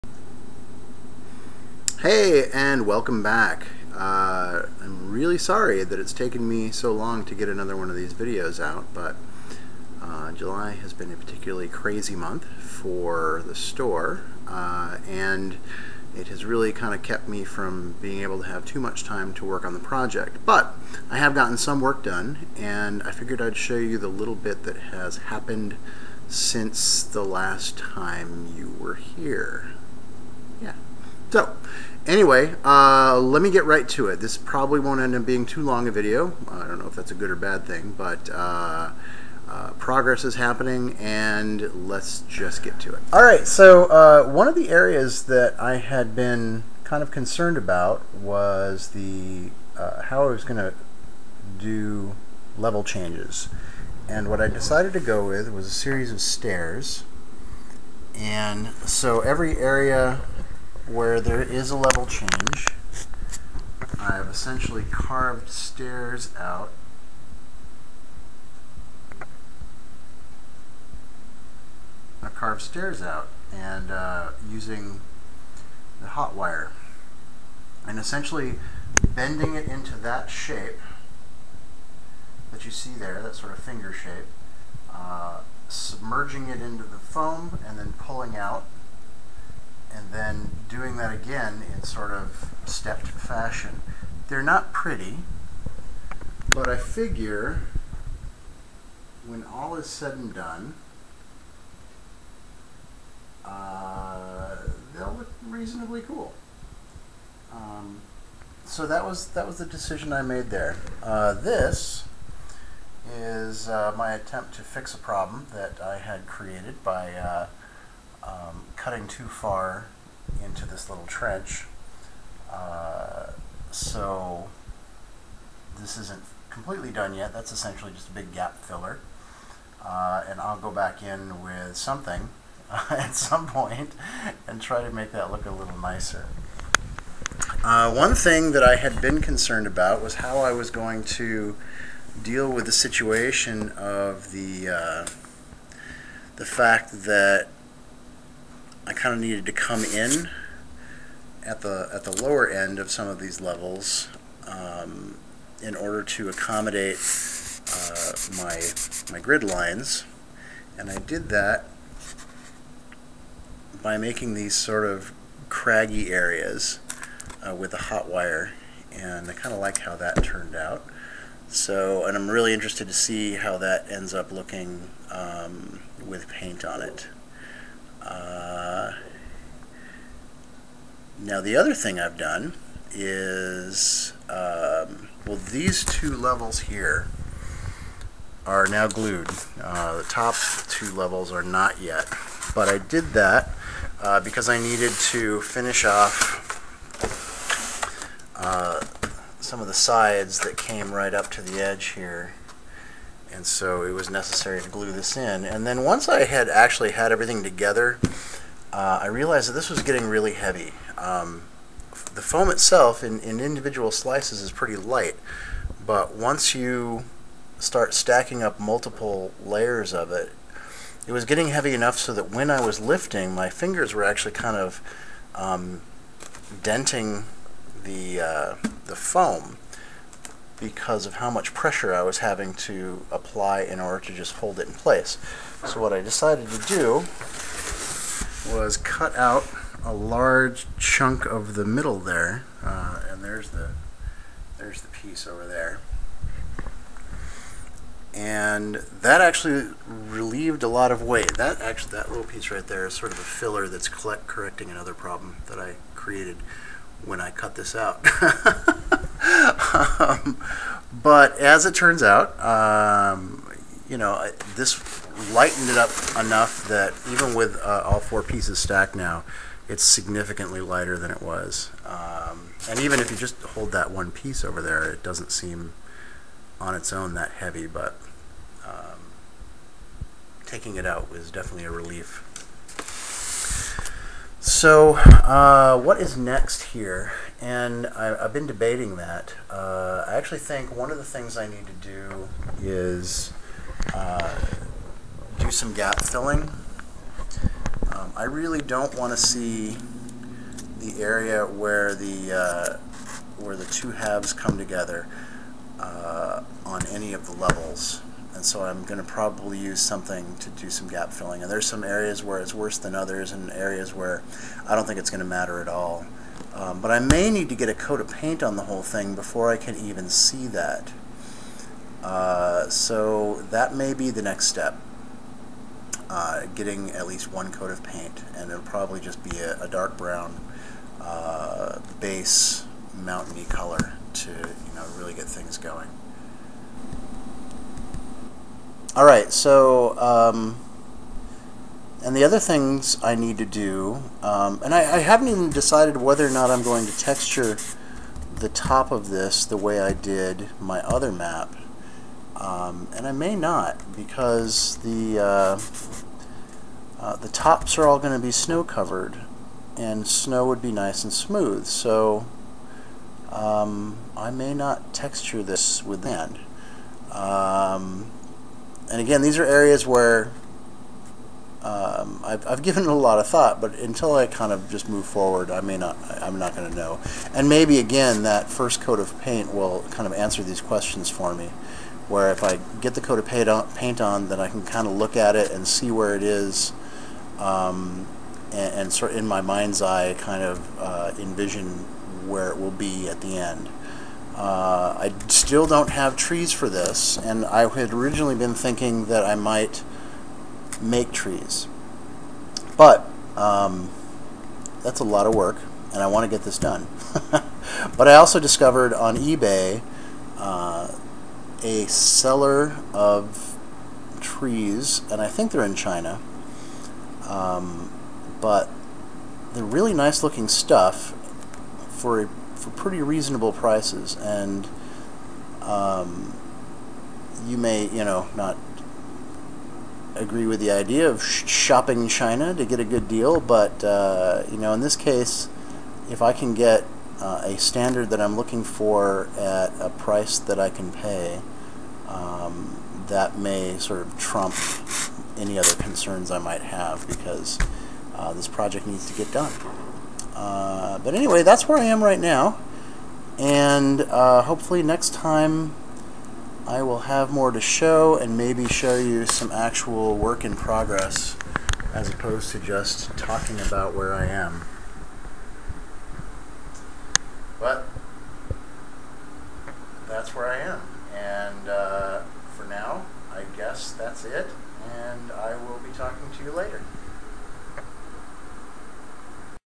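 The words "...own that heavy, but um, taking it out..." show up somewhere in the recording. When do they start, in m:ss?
4:36.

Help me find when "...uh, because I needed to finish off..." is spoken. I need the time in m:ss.
3:14.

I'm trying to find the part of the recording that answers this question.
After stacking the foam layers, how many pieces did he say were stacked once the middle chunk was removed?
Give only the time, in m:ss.
4:27.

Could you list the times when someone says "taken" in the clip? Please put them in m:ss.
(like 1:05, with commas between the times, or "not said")
0:06.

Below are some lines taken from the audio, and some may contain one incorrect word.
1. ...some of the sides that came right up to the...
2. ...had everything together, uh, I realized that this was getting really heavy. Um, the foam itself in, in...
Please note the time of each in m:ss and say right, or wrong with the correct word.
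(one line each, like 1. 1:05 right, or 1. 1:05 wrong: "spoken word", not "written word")
1. 3:19 right
2. 3:26 right.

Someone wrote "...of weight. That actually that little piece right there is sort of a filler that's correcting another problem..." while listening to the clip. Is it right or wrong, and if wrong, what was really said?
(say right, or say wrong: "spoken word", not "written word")
right.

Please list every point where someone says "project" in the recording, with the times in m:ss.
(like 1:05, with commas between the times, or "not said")
0:19, 7:28.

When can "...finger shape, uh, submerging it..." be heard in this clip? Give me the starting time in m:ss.
1:23.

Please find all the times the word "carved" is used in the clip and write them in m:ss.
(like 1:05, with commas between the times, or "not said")
1:04, 1:12.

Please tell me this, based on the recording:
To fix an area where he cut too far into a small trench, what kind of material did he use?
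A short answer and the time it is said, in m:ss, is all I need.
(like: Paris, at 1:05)
gap filler, at 2:08.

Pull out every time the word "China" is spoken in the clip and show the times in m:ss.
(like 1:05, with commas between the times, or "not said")
6:55, 7:12.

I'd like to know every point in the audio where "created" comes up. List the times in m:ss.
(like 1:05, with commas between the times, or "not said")
1:56, 4:15.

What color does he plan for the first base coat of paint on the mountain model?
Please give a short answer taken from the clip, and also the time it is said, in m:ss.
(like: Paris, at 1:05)
dark brown, at 5:29.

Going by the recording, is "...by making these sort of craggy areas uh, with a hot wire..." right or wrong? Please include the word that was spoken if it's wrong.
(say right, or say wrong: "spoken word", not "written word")
right.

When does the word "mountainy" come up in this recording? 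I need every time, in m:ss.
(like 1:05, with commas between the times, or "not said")
5:32.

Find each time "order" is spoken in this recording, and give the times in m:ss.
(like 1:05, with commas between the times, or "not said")
2:35, 3:53.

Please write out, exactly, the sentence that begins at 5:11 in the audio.
And there's some areas where it's worse than others and areas where I don't think it's going to matter at all.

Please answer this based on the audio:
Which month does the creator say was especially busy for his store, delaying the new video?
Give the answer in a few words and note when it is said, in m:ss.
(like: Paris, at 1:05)
July, at 0:10.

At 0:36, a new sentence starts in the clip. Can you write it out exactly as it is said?
I don't know if that's a good or bad thing, but uh, uh, progress is happening, and let's just get to it.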